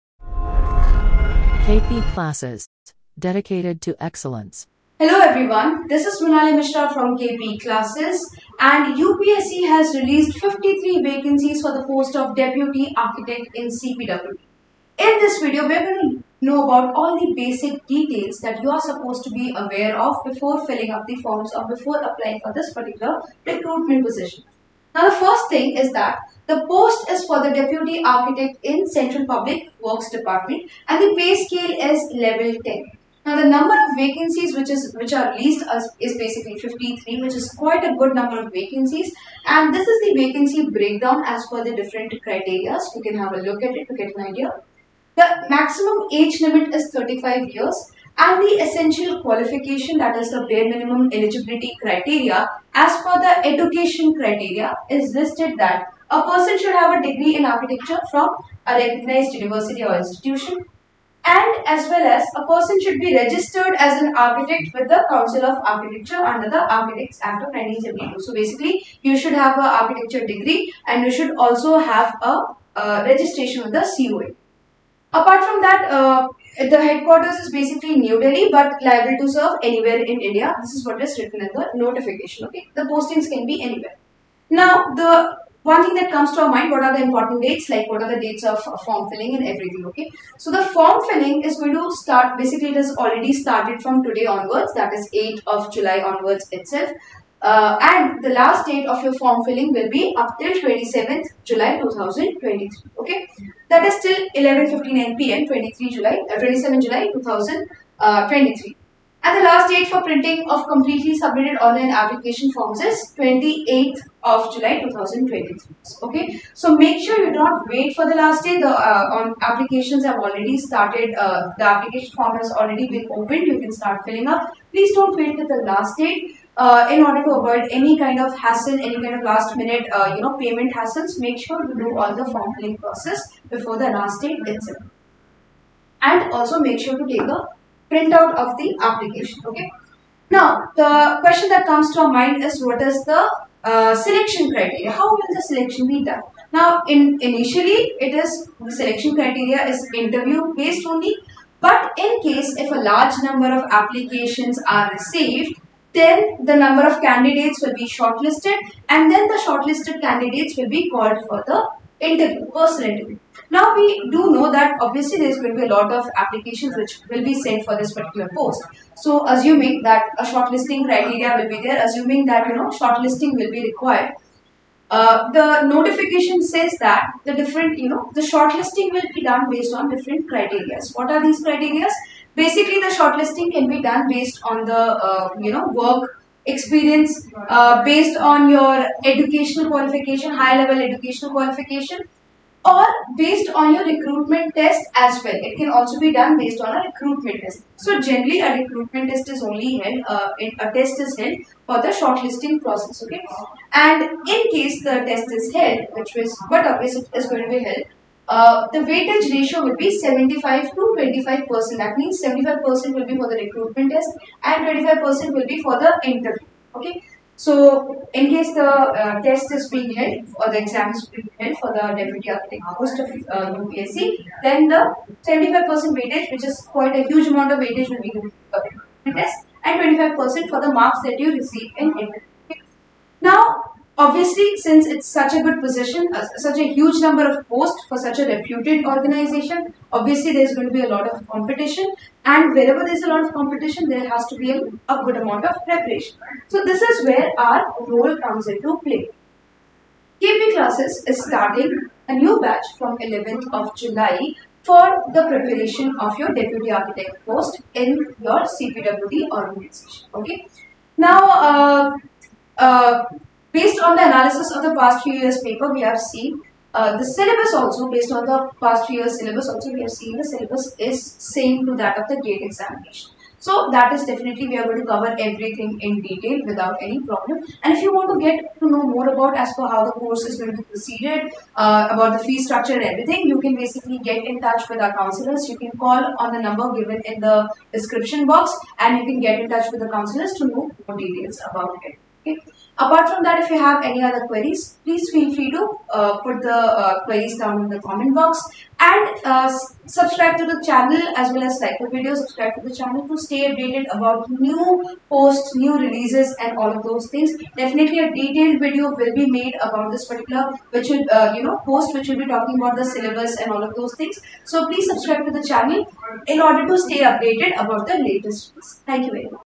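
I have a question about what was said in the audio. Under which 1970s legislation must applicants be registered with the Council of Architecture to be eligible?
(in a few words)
Architects Act of 1972.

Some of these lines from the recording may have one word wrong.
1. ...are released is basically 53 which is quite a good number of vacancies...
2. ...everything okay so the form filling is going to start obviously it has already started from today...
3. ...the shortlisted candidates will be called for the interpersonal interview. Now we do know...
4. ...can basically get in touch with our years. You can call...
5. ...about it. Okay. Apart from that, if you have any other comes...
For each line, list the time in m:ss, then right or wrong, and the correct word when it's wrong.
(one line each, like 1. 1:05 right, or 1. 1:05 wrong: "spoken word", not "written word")
1. 0:35 right
2. 1:29 wrong: "basically", not "obviously"
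3. 2:39 right
4. 4:43 wrong: "counselors", not "years"
5. 4:51 wrong: "queries", not "comes".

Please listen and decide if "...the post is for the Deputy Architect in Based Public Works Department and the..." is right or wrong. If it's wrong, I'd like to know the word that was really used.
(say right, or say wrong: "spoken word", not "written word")
wrong: "Central", not "Based".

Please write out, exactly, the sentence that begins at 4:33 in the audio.
So that is definitely we are going to cover everything in detail without any problem.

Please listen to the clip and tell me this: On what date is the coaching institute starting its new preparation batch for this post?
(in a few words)
11 July.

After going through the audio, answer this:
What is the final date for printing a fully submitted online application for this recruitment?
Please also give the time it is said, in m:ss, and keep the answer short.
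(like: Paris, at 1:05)
28 July 2023, at 1:53.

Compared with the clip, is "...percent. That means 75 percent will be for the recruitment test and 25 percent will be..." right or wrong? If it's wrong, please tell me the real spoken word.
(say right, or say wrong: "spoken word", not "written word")
right.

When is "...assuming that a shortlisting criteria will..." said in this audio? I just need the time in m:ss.
2:49.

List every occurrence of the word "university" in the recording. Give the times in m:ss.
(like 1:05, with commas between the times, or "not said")
0:59.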